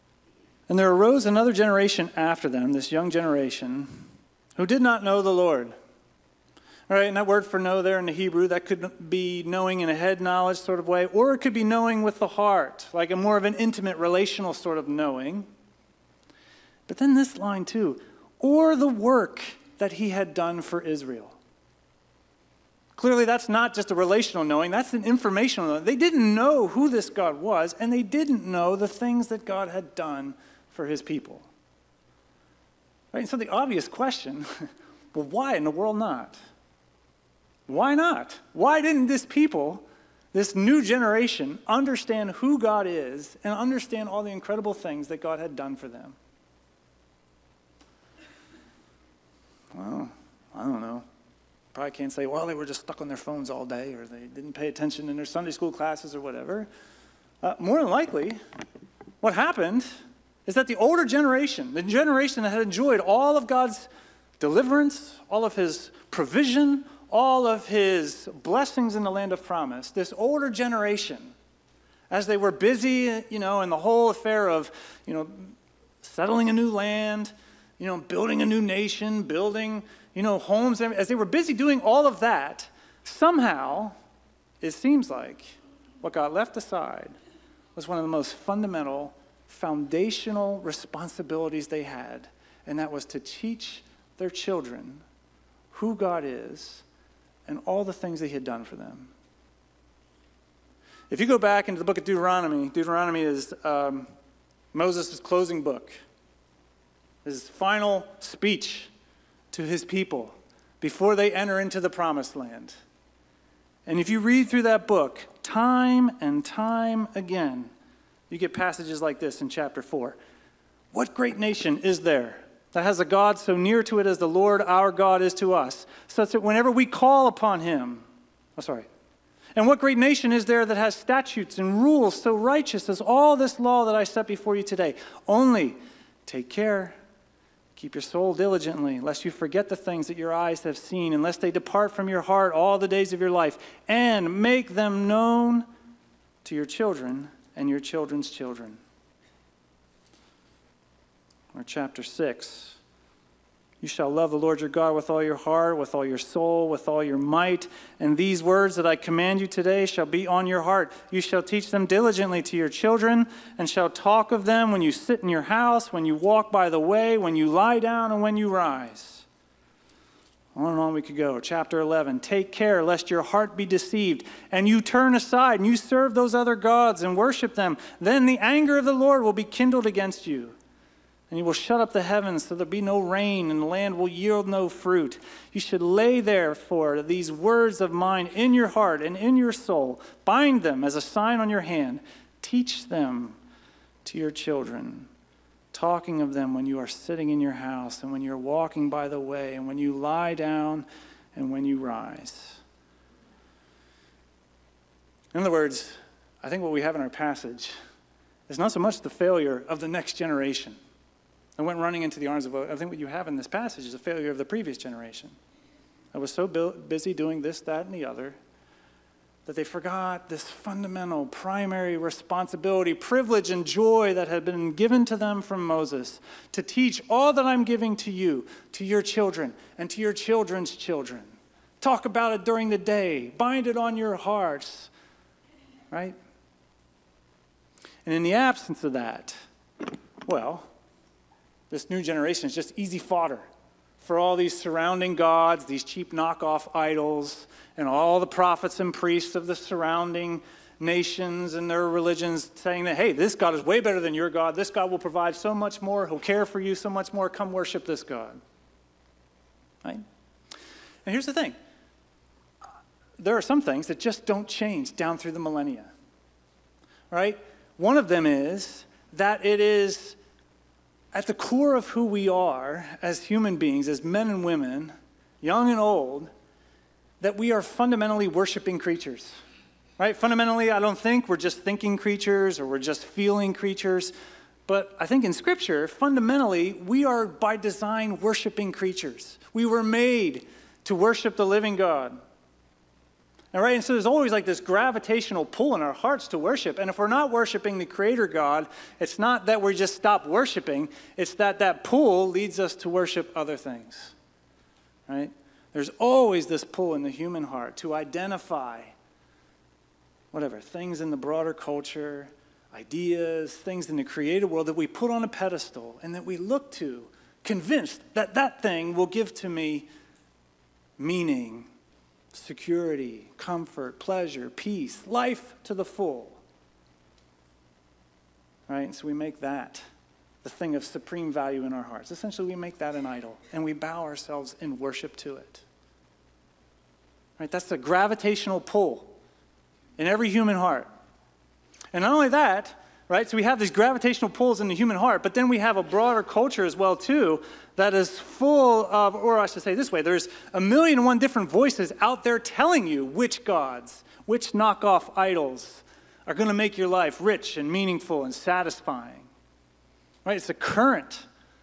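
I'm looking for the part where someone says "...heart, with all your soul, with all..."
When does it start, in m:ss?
2:35.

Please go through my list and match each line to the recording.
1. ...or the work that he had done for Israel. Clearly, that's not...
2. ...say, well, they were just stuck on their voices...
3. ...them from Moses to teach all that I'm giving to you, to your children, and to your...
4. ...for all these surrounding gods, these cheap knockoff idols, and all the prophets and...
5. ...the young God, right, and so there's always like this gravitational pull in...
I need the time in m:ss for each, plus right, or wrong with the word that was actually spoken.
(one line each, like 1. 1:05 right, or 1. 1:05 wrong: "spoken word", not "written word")
1. 0:18 right
2. 0:52 wrong: "phones", not "voices"
3. 3:45 right
4. 4:03 right
5. 4:51 wrong: "living", not "young".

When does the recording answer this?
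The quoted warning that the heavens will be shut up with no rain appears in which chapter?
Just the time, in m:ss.
2:51.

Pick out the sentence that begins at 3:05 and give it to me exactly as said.
You should lay therefore these words of mine in your heart and in your soul.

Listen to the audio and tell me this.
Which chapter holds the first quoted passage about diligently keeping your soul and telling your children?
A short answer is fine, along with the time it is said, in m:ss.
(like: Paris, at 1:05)
Chapter 4, at 1:59.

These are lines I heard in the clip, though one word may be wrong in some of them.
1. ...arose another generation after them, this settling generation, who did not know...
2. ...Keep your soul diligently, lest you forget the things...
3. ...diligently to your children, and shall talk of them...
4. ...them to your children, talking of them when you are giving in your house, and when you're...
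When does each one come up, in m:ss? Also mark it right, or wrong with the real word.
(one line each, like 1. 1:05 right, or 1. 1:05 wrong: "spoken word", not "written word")
1. 0:00 wrong: "young", not "settling"
2. 2:17 right
3. 2:41 right
4. 3:12 wrong: "sitting", not "giving".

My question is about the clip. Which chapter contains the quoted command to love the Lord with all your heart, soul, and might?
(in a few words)
Chapter 6.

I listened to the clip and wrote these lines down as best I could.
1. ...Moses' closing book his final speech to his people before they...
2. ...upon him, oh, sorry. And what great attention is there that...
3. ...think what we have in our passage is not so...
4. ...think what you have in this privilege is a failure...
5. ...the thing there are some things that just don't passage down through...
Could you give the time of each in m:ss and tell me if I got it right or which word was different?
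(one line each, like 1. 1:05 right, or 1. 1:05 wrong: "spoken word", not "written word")
1. 1:44 right
2. 2:07 wrong: "nation", not "attention"
3. 3:26 right
4. 3:32 wrong: "passage", not "privilege"
5. 4:21 wrong: "change", not "passage".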